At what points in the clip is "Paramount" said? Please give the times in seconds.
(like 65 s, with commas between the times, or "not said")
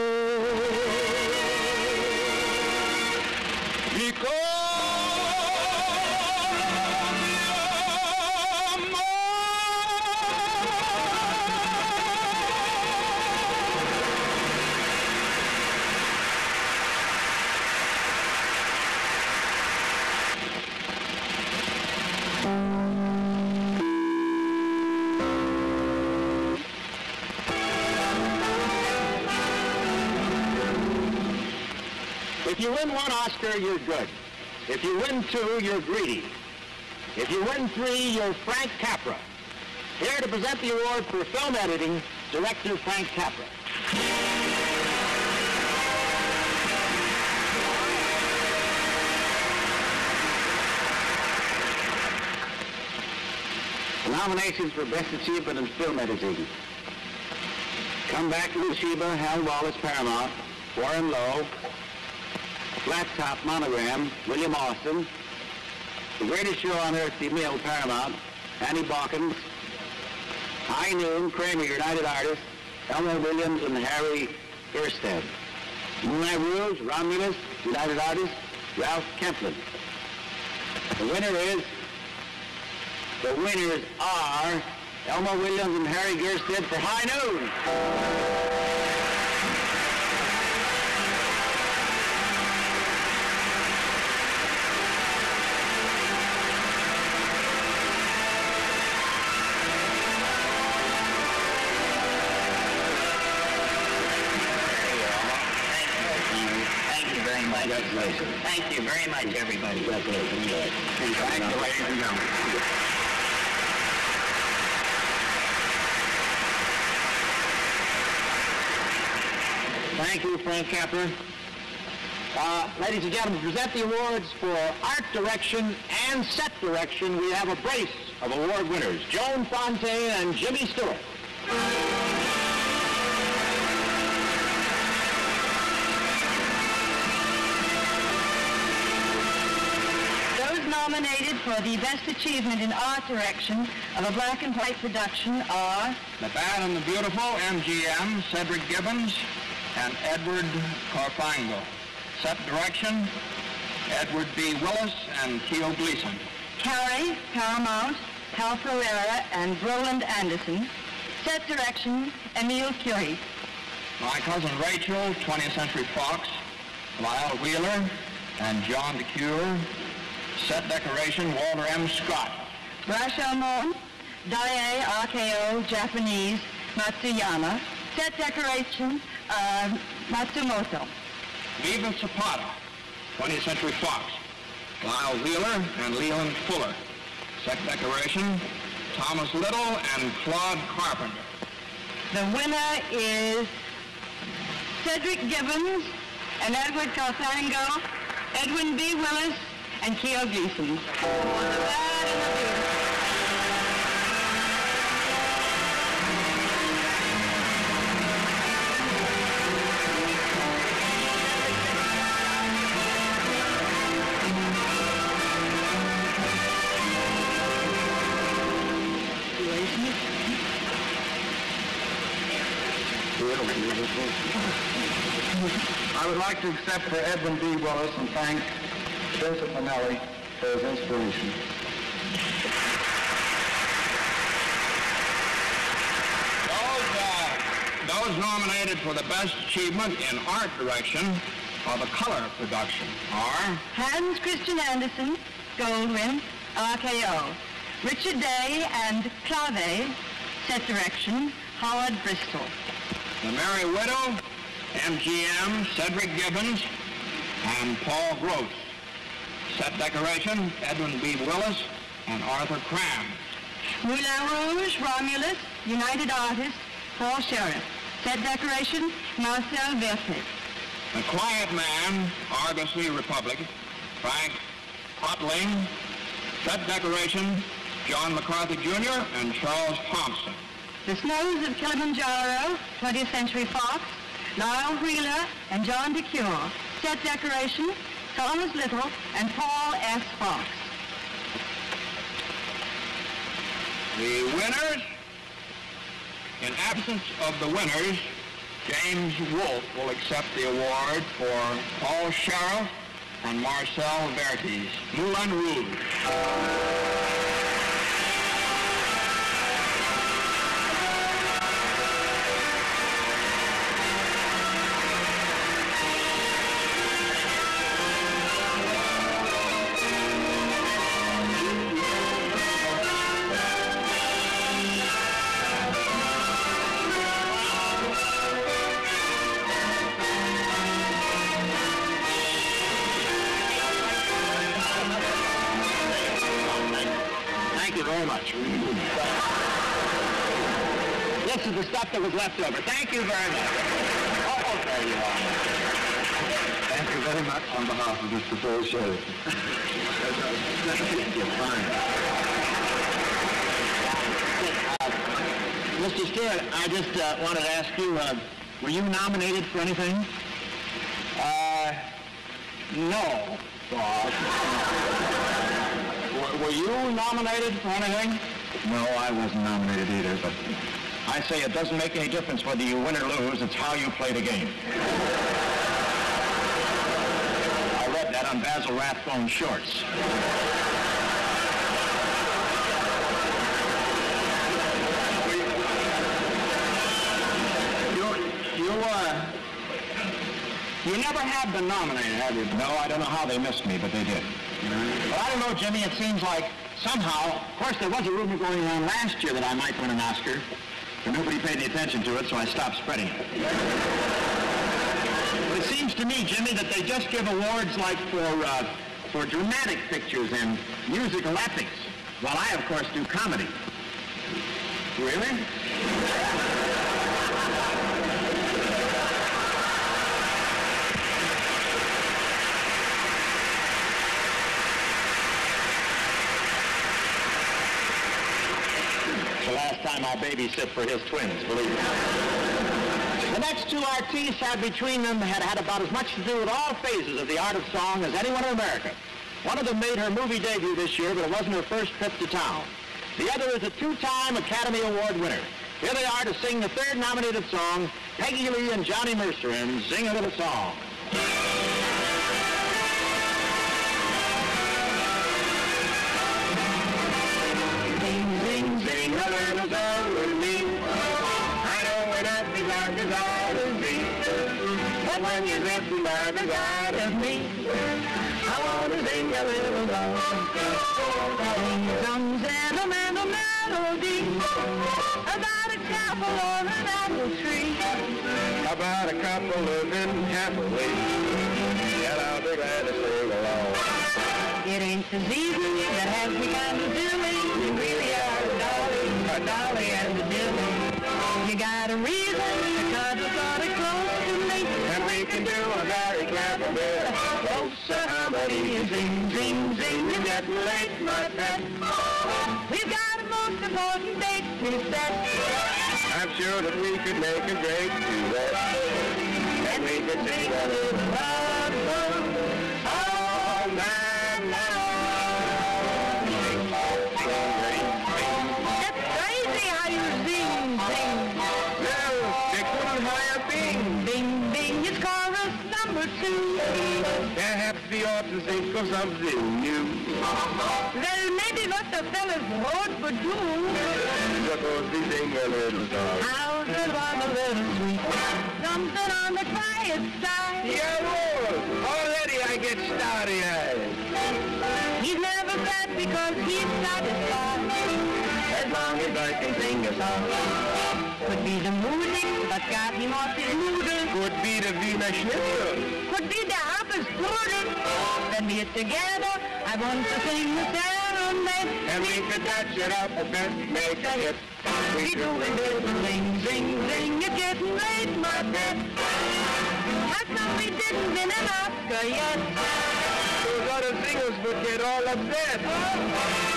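59 s, 67 s, 157 s.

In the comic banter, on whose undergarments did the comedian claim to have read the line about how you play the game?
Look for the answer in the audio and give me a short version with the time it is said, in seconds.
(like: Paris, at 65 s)
Basil Rathbone, at 378 s.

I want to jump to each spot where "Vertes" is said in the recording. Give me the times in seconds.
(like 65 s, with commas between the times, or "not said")
269 s, 304 s.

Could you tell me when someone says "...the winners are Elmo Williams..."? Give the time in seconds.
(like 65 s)
83 s.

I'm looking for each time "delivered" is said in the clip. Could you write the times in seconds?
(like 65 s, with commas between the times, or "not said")
not said.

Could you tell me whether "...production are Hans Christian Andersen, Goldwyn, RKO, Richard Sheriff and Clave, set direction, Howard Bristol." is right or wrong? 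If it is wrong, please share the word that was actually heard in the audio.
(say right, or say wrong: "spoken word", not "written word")
wrong: "Day", not "Sheriff".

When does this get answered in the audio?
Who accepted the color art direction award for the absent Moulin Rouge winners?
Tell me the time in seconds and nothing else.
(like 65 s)
298 s.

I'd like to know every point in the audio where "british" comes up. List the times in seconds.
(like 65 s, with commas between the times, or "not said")
not said.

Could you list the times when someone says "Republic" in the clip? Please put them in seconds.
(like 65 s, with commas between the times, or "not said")
272 s.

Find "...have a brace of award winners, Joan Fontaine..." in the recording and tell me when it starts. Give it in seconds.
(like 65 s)
127 s.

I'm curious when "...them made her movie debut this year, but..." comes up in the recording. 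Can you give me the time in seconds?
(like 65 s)
439 s.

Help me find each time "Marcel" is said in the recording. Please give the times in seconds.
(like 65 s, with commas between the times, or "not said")
269 s, 303 s.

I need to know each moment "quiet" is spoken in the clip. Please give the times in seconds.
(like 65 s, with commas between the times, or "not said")
271 s, 539 s.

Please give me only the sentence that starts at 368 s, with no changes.
No, I wasn't nominated either, but I say it doesn't make any difference whether you win or lose.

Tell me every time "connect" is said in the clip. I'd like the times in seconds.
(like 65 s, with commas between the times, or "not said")
not said.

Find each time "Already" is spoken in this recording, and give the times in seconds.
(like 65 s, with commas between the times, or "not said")
541 s.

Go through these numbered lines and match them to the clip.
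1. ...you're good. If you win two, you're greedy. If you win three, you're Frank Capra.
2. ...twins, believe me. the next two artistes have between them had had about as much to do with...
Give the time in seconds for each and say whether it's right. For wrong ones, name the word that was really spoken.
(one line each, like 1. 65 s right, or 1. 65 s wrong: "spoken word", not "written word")
1. 33 s right
2. 431 s right.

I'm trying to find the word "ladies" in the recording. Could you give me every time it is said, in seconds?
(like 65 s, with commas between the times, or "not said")
111 s, 122 s.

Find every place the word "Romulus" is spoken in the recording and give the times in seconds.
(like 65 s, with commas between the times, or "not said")
76 s, 264 s.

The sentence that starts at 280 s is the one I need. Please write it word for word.
The Snows of Kilimanjaro, 20th Century Fox, Lyle Wheeler, and John DeCuir.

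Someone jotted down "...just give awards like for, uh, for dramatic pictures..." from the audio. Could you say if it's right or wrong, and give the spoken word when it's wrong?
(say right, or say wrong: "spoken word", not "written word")
right.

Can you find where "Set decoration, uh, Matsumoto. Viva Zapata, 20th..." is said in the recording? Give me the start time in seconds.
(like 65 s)
177 s.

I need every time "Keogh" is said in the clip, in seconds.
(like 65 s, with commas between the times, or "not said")
155 s, 199 s.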